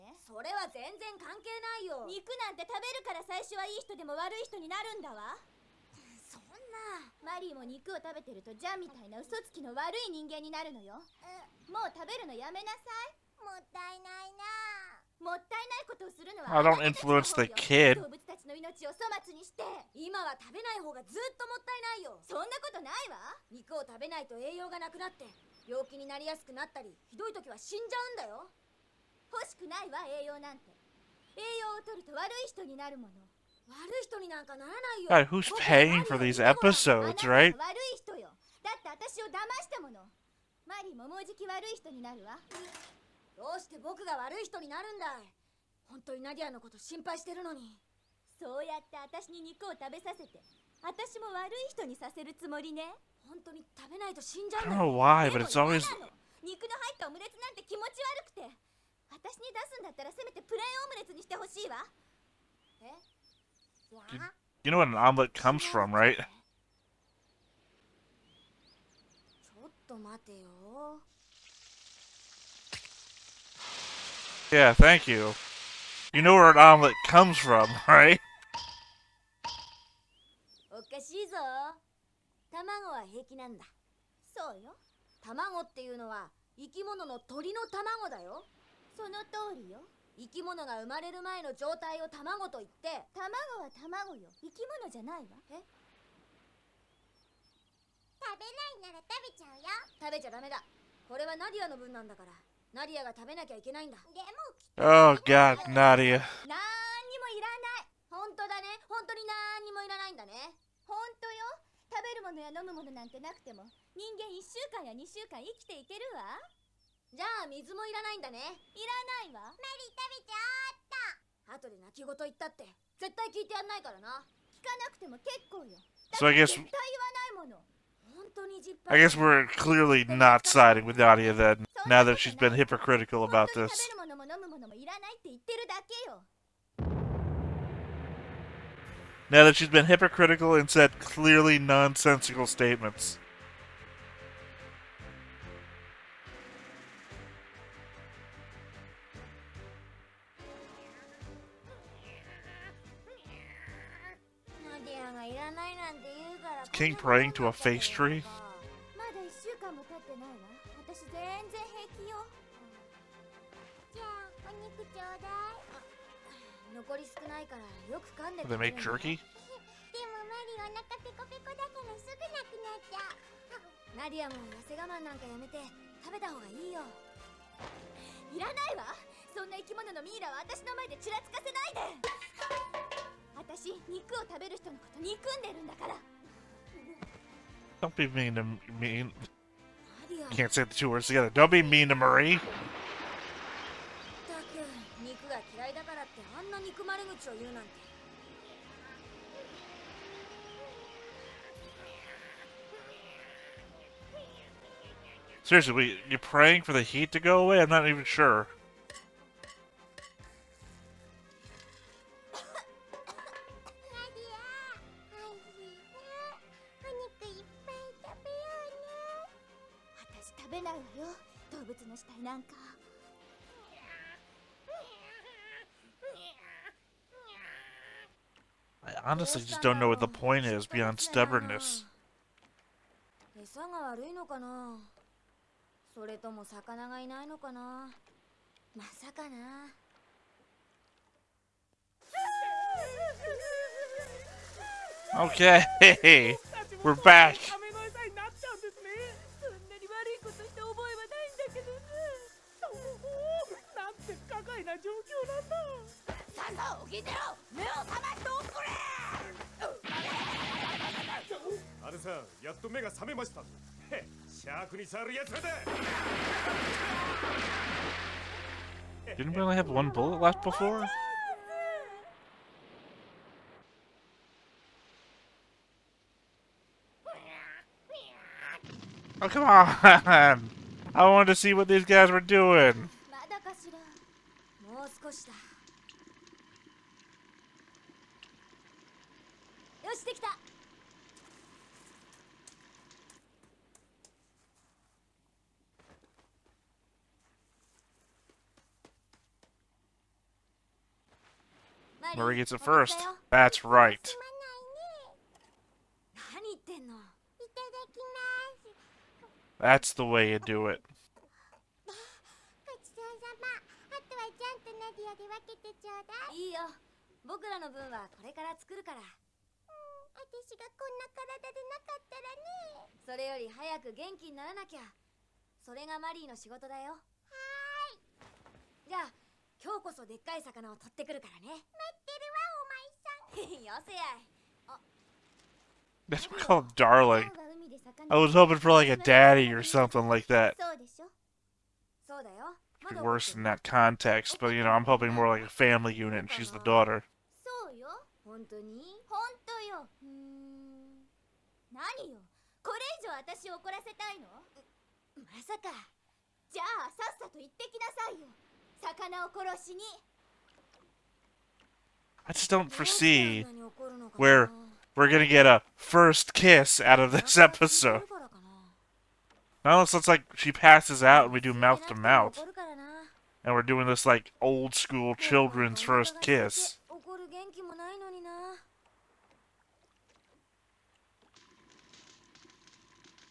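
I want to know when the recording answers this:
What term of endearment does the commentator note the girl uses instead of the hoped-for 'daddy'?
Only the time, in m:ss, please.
5:36.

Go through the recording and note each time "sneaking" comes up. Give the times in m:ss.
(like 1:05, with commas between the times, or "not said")
not said.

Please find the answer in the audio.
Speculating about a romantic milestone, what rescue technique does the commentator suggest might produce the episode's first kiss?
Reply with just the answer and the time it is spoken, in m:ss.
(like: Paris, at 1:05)
mouth to mouth, at 6:11.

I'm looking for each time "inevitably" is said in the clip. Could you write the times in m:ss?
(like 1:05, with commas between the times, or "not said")
not said.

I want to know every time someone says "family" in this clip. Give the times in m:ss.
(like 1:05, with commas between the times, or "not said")
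5:45.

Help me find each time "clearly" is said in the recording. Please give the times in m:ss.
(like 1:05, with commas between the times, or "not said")
2:09, 2:20.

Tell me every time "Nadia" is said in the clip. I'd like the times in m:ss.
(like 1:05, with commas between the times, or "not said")
1:45, 2:10.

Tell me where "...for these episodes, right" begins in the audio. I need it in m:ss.
0:36.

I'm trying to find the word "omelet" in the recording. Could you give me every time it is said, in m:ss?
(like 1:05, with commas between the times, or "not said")
1:04, 1:16.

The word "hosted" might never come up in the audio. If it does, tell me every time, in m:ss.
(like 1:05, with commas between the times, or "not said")
not said.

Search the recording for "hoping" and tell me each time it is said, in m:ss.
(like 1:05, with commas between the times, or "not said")
5:38, 5:44.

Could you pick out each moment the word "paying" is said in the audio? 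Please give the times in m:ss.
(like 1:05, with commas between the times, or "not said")
0:35.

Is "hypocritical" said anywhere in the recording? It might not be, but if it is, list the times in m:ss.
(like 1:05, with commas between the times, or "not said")
2:12, 2:19.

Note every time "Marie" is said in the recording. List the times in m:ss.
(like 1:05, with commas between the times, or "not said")
3:11.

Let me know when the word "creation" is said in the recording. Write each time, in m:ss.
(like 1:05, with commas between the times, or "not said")
not said.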